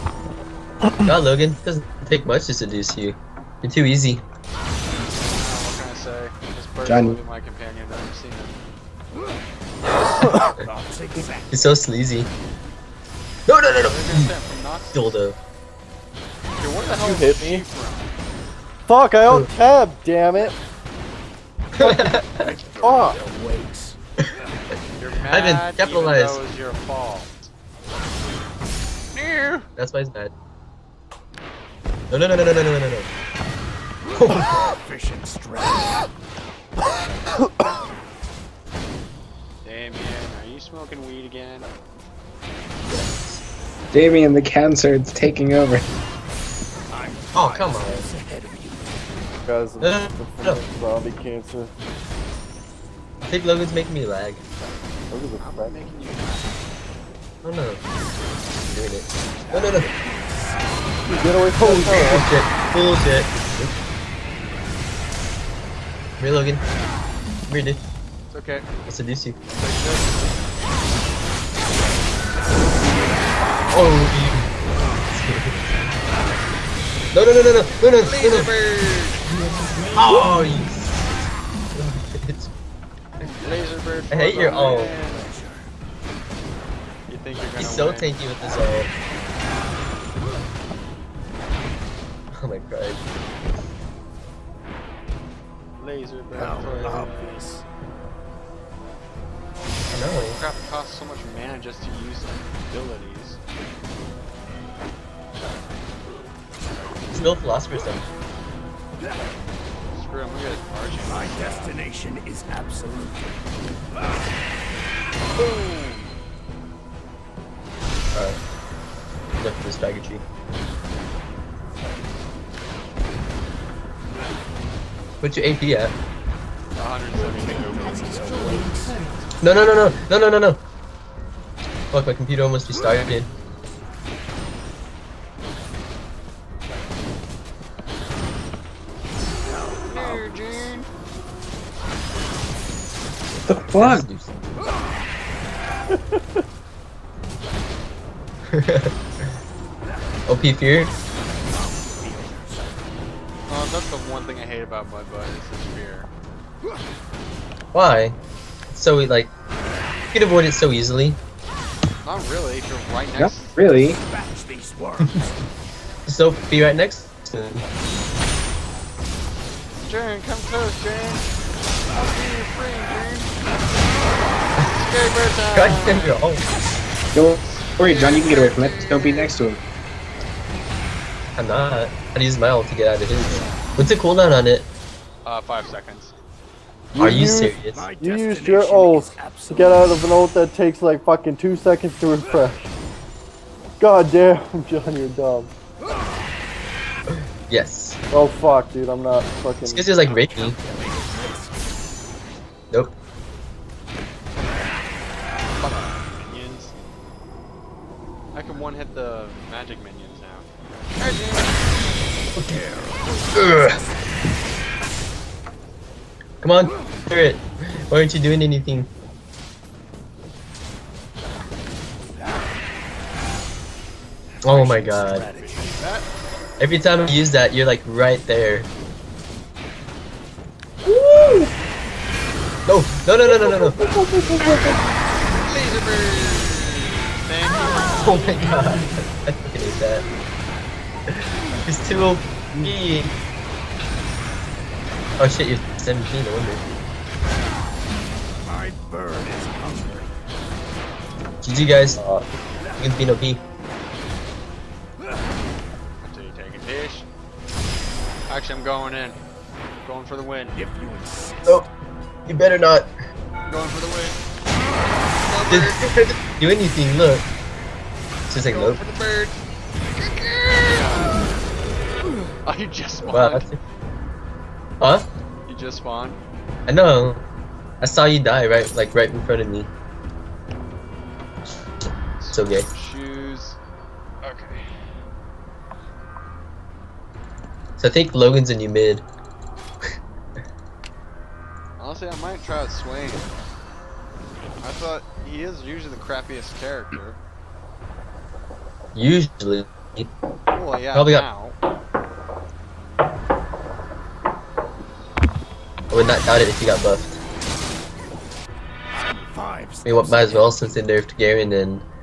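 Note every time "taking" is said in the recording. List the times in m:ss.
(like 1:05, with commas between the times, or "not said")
0:45.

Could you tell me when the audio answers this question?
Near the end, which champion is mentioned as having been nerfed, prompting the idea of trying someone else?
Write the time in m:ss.
5:11.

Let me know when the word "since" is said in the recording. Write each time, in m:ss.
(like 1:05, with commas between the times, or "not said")
5:10.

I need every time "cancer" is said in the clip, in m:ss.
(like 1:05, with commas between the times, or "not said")
0:44, 0:51.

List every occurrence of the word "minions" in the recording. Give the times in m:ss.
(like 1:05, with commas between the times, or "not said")
3:29.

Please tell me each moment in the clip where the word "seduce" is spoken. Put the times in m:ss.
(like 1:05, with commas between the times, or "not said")
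0:02, 1:08.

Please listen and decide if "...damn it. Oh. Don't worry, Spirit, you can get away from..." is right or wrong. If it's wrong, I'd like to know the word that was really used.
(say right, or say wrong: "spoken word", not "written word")
wrong: "John", not "Spirit".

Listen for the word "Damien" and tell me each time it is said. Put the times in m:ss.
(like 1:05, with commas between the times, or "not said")
0:39, 0:43.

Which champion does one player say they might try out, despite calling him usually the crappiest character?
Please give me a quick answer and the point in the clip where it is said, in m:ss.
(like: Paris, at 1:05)
Swain, at 4:52.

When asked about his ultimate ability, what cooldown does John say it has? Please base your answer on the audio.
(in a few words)
5 seconds.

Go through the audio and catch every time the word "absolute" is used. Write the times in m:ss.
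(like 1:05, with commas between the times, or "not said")
1:52.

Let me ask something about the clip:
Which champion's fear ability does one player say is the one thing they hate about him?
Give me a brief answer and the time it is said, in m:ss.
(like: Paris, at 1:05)
Mudbot, at 2:34.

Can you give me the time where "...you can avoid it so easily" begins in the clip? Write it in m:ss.
2:39.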